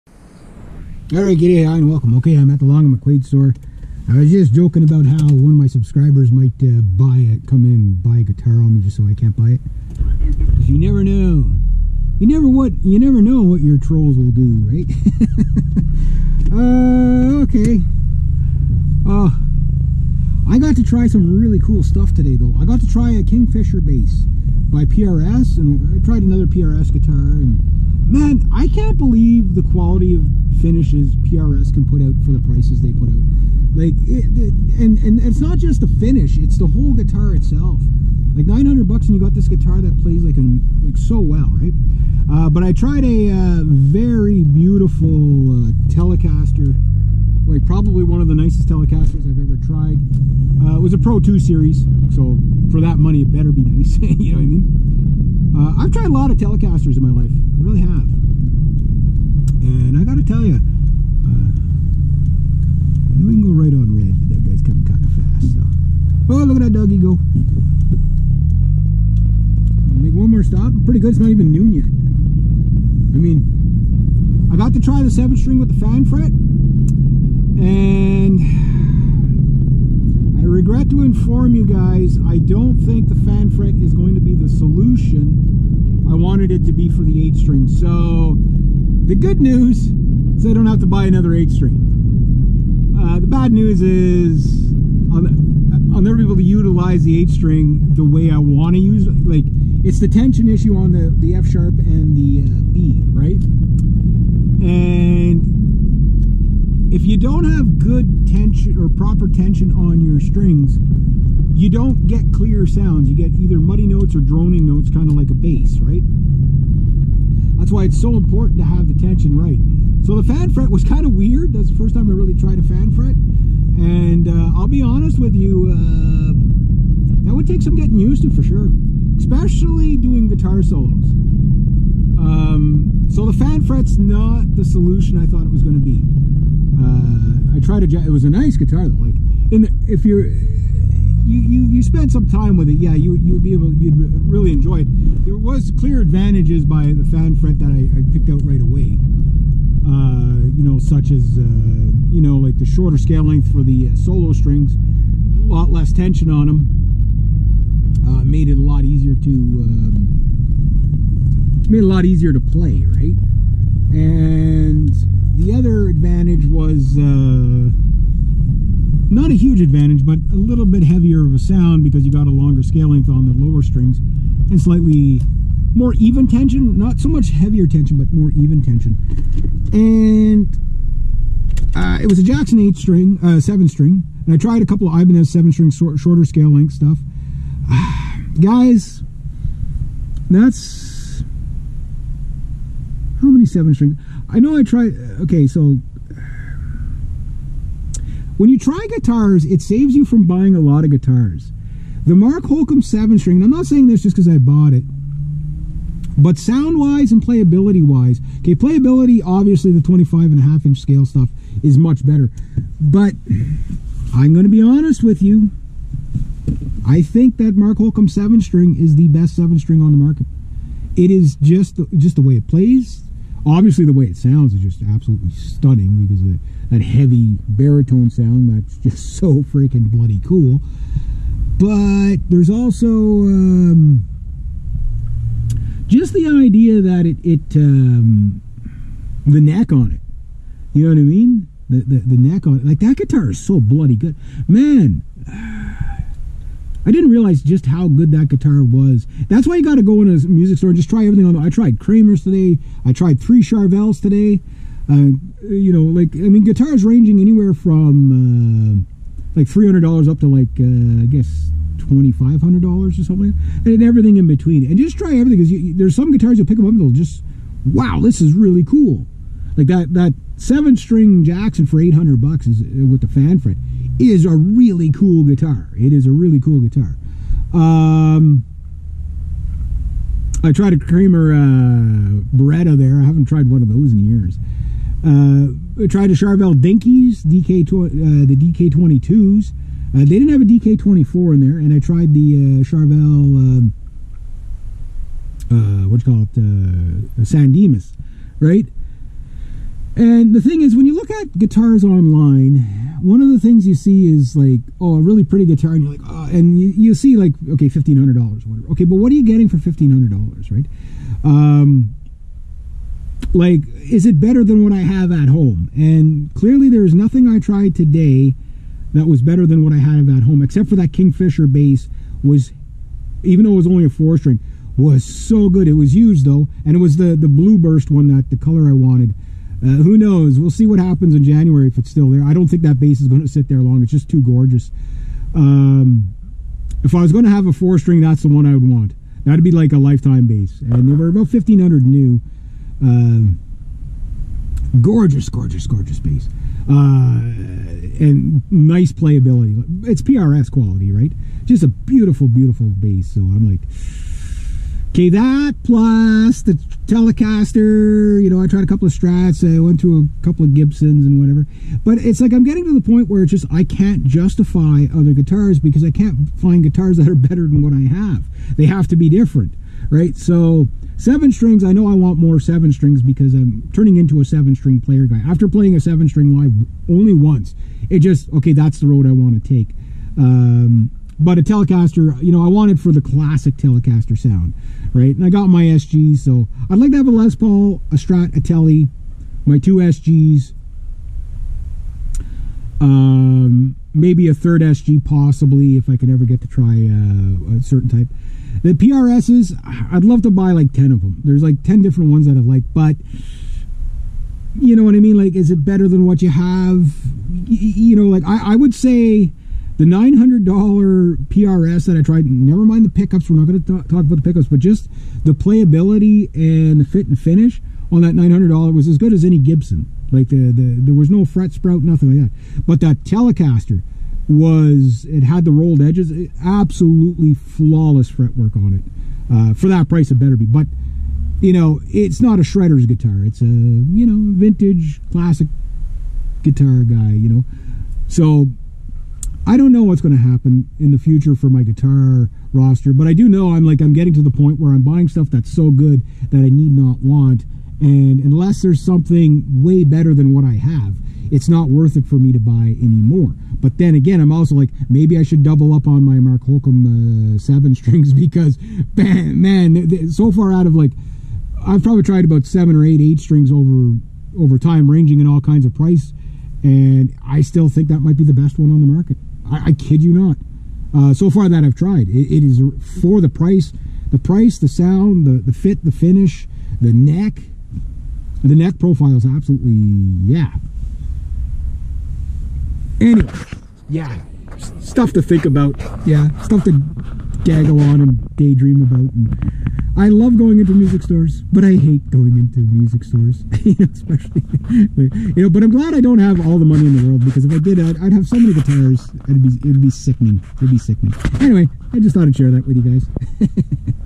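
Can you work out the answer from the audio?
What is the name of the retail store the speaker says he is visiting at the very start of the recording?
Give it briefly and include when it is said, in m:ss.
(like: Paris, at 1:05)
Long and McQuade, at 0:02.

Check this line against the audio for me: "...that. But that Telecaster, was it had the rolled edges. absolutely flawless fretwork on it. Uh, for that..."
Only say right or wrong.
right.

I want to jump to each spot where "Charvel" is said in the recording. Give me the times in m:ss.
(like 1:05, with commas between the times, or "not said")
4:13, 4:46, 4:52.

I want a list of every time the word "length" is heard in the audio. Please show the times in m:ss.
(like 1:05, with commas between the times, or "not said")
2:33, 2:52, 3:06.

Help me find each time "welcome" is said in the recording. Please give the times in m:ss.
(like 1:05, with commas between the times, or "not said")
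0:01.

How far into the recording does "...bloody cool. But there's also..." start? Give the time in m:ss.
3:49.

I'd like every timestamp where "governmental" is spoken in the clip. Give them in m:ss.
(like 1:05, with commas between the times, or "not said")
not said.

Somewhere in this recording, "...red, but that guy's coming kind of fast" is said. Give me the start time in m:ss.
1:03.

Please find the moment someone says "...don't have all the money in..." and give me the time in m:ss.
8:16.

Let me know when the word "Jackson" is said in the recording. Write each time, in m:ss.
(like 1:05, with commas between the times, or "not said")
3:02, 4:31.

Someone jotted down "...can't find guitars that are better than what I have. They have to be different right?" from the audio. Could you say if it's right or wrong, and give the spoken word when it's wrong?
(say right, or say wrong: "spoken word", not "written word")
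right.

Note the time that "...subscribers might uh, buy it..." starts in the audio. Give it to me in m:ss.
0:05.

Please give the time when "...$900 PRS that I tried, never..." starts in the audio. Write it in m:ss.
6:49.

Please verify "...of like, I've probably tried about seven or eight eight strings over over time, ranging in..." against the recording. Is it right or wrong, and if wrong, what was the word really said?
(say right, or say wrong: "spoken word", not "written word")
right.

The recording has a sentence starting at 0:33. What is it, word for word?
Like, it, it, and and it's not just the finish; it's the whole guitar itself.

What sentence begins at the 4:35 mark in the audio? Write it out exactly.
It is a really cool guitar.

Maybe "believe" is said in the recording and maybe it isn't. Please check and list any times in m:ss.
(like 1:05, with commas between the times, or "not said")
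0:28.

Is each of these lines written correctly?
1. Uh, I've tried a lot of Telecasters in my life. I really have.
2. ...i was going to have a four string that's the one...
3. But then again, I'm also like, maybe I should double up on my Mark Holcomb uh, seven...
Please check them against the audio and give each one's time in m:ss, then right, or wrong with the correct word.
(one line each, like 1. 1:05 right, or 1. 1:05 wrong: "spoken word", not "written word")
1. 0:55 right
2. 5:36 right
3. 7:33 right.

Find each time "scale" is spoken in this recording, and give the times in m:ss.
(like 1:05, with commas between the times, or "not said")
2:32, 2:52, 3:06, 3:30.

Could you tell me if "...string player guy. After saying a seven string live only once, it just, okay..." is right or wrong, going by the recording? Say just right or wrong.
wrong.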